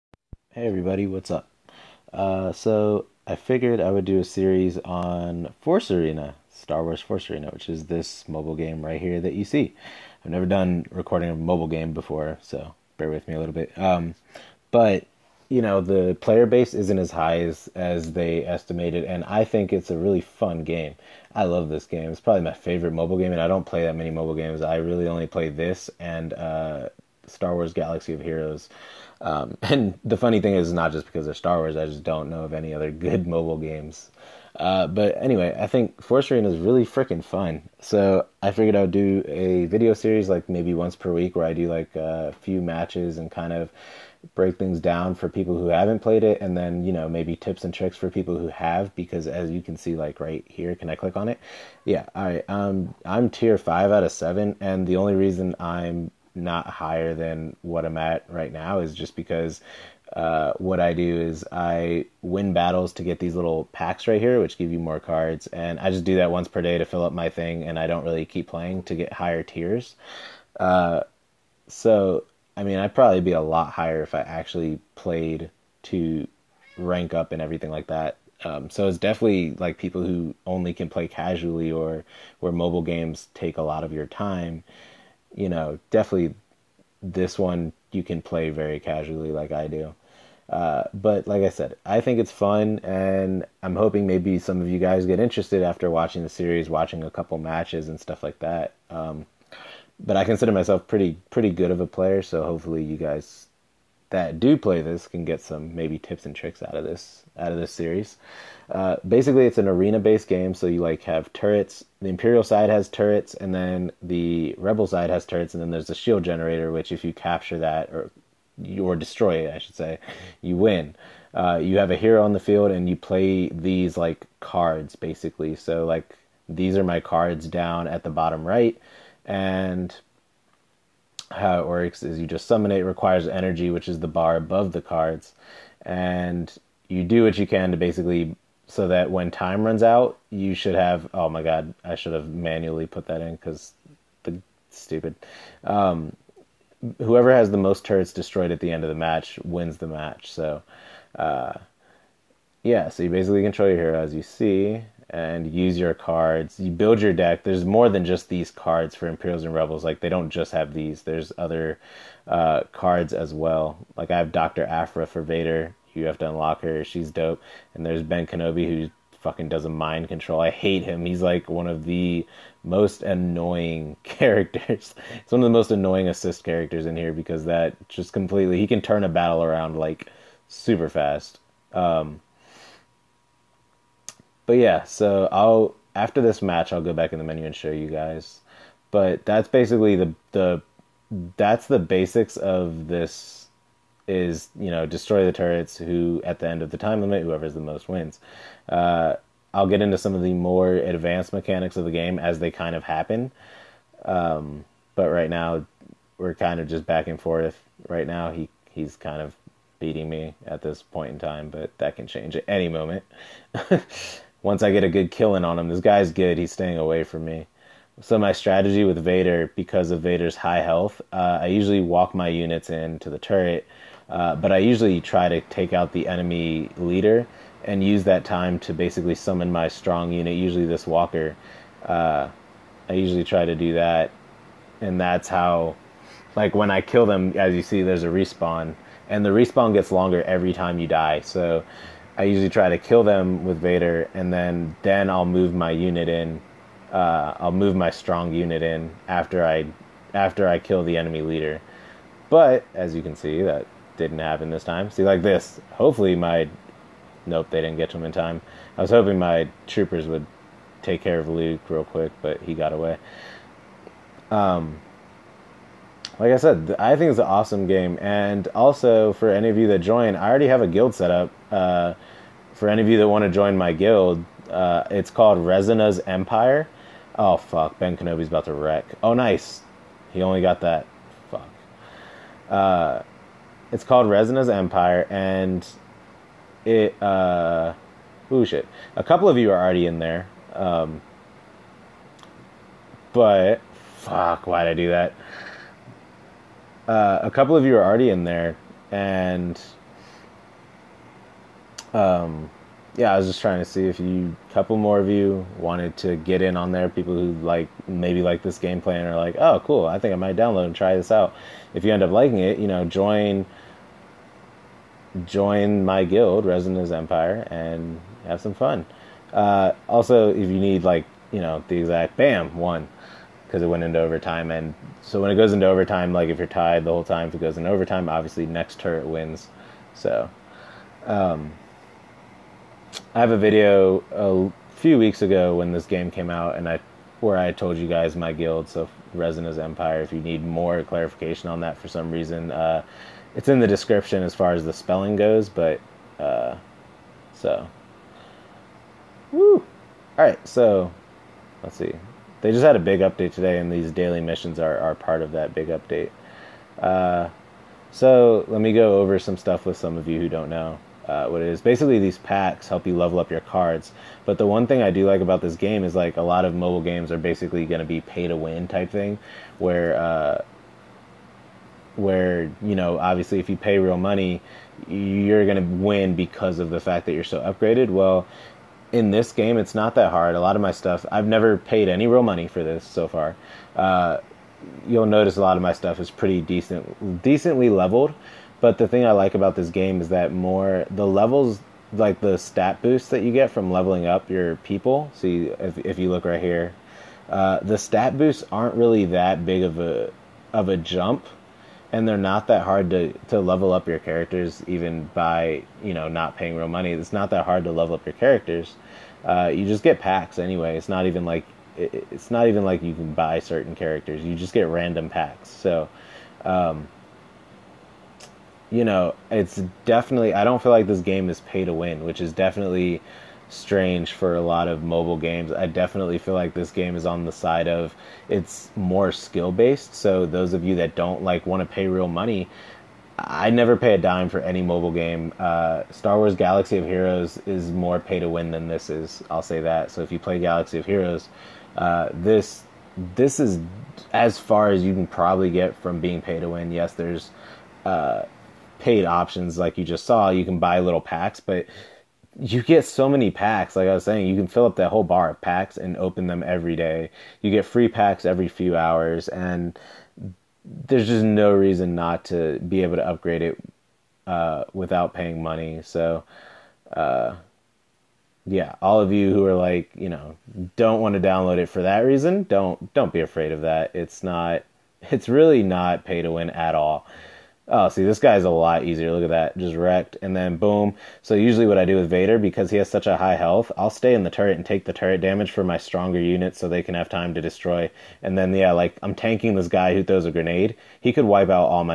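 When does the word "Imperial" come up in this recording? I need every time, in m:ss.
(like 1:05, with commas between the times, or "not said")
1:52, 2:39.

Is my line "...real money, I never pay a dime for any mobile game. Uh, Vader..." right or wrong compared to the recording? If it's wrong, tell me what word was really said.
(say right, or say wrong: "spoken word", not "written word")
wrong: "Star", not "Vader".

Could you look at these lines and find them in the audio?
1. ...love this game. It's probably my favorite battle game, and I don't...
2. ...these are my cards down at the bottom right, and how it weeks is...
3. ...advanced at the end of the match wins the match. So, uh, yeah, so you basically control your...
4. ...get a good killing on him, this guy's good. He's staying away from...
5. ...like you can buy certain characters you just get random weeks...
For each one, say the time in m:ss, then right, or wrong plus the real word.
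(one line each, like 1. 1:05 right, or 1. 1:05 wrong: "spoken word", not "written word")
1. 0:21 wrong: "mobile", not "battle"
2. 2:06 wrong: "works", not "weeks"
3. 2:28 wrong: "destroyed", not "advanced"
4. 3:34 right
5. 6:52 wrong: "packs", not "weeks".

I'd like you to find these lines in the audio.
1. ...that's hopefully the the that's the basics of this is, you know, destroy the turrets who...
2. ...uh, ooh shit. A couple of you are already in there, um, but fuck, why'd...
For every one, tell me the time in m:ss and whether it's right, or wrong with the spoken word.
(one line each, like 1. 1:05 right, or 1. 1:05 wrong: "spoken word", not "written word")
1. 3:09 wrong: "basically", not "hopefully"
2. 4:47 right.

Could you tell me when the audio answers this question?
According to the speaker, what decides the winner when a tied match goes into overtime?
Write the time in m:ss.
5:28.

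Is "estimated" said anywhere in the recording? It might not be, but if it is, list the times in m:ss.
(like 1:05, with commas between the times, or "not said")
0:18.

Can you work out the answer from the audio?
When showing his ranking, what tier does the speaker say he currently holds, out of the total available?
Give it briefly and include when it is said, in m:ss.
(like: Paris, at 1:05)
5, at 0:53.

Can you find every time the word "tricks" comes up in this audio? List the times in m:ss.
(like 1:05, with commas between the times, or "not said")
0:47, 1:46.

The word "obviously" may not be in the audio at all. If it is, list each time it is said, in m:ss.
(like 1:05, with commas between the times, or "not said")
5:28, 6:12.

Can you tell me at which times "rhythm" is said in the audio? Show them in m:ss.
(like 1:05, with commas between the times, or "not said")
not said.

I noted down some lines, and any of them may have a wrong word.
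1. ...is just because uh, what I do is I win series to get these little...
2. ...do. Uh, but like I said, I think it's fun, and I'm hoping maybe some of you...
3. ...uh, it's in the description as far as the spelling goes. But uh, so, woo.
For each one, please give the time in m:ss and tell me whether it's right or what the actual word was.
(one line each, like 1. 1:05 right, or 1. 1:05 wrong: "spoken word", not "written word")
1. 0:58 wrong: "battles", not "series"
2. 1:29 right
3. 5:42 right.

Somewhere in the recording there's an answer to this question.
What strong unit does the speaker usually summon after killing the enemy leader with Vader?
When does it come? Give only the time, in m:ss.
3:50.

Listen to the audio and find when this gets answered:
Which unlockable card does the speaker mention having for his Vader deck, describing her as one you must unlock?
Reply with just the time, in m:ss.
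2:44.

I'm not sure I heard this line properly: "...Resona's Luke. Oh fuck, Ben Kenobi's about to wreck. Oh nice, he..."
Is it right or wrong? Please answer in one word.
wrong.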